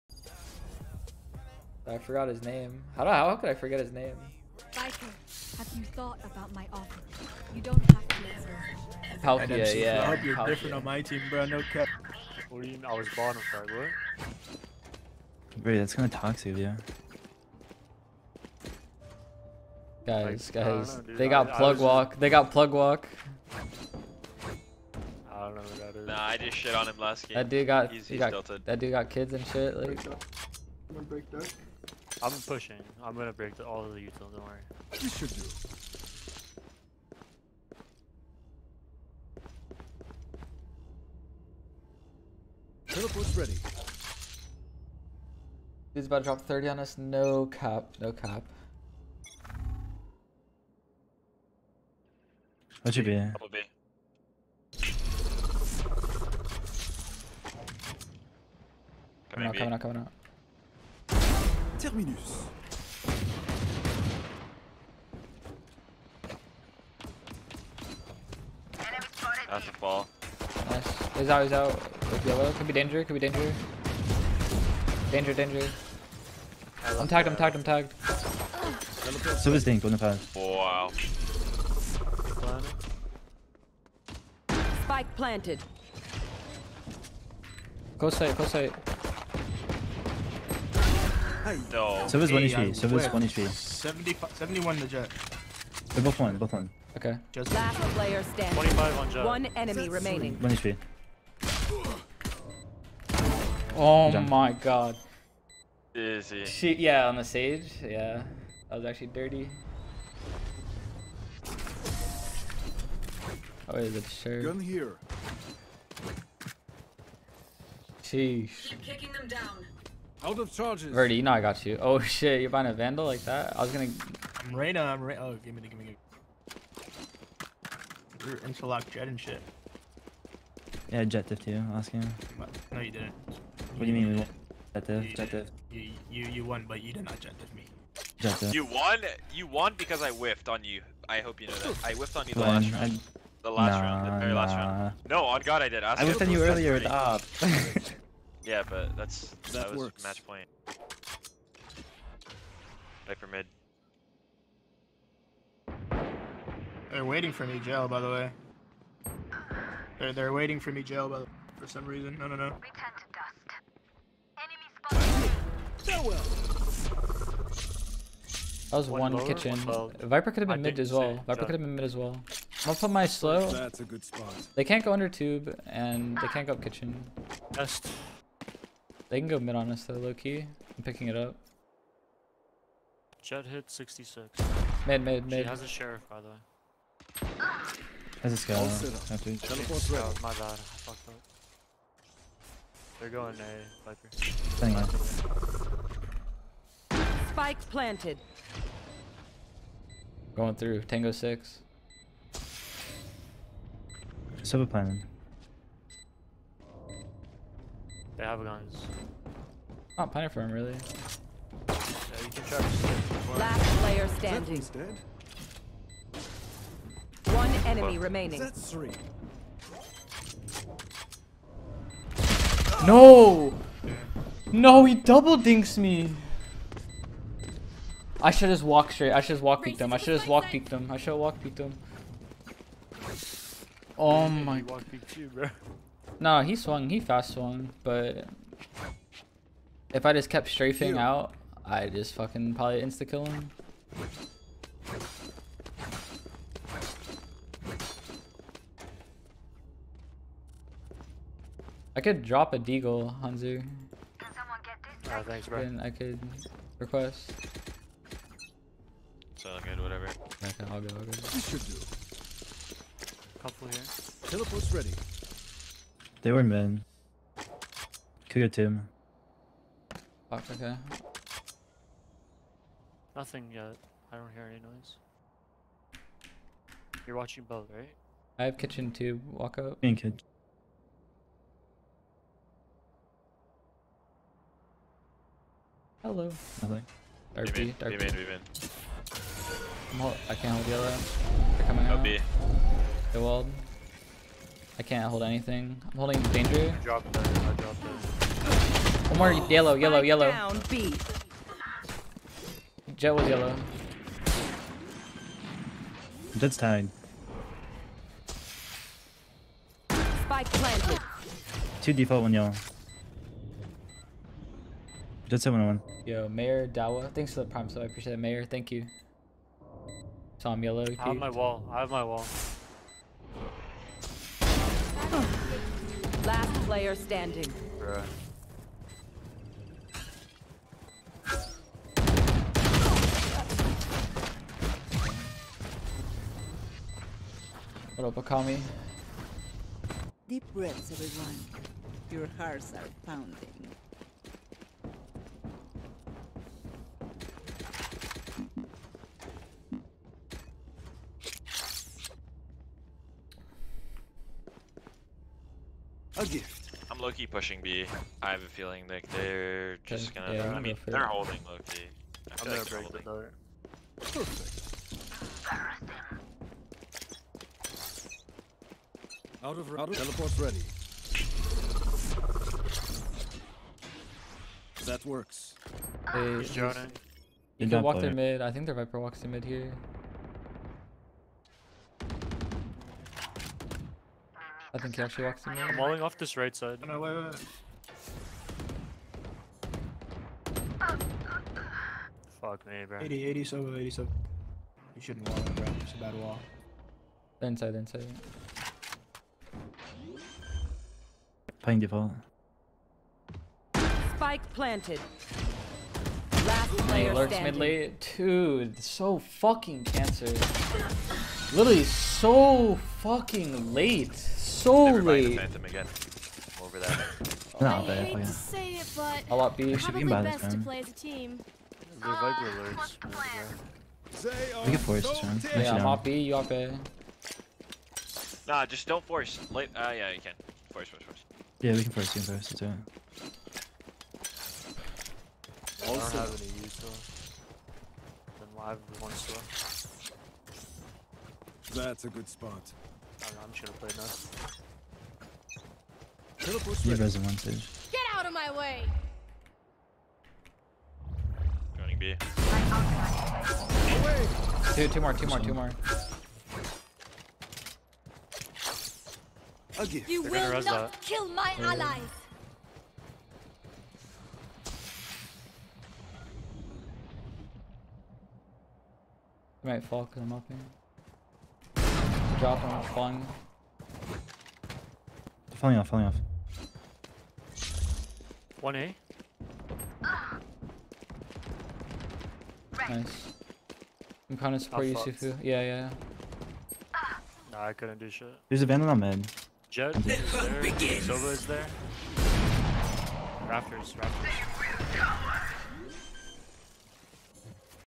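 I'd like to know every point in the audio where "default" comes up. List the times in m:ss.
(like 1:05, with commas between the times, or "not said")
5:11, 6:41.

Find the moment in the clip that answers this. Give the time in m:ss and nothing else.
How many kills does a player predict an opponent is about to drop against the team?
0:46.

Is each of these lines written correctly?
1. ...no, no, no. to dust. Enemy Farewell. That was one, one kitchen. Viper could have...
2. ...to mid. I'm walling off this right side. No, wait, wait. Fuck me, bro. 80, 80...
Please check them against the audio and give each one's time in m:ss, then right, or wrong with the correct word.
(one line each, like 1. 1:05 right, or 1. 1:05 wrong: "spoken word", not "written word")
1. 2:42 right
2. 6:25 right.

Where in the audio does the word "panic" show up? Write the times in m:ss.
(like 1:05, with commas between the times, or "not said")
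not said.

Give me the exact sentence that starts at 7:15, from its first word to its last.
I don't have any use though.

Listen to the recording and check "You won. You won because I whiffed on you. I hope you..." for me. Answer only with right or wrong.
right.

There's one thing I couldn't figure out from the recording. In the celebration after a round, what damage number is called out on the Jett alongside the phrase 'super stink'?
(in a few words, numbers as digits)
25.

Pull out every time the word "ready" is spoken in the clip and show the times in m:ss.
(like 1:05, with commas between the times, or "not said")
0:43, 4:24, 6:10.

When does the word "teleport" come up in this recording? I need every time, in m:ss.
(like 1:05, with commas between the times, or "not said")
0:42, 3:08, 4:24, 6:09.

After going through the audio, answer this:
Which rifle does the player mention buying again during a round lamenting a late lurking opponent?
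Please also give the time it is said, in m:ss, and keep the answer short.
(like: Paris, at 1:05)
Phantom, at 6:55.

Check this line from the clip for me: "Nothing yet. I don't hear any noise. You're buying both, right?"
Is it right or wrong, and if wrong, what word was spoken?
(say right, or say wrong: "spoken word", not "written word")
wrong: "watching", not "buying".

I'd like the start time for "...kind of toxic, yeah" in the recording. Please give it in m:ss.
0:15.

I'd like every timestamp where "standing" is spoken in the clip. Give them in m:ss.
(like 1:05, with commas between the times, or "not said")
1:38, 3:34, 5:26.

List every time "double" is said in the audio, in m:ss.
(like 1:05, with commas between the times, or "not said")
0:53, 3:44.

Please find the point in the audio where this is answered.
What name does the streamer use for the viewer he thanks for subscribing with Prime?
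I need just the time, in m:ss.
5:16.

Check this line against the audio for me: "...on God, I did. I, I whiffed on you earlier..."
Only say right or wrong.
right.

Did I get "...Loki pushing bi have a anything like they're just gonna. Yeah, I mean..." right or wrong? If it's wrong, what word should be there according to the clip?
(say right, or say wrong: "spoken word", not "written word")
wrong: "feeling", not "anything".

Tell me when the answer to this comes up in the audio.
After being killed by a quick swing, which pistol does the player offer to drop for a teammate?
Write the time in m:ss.
4:12.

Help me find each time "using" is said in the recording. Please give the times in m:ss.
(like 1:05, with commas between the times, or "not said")
not said.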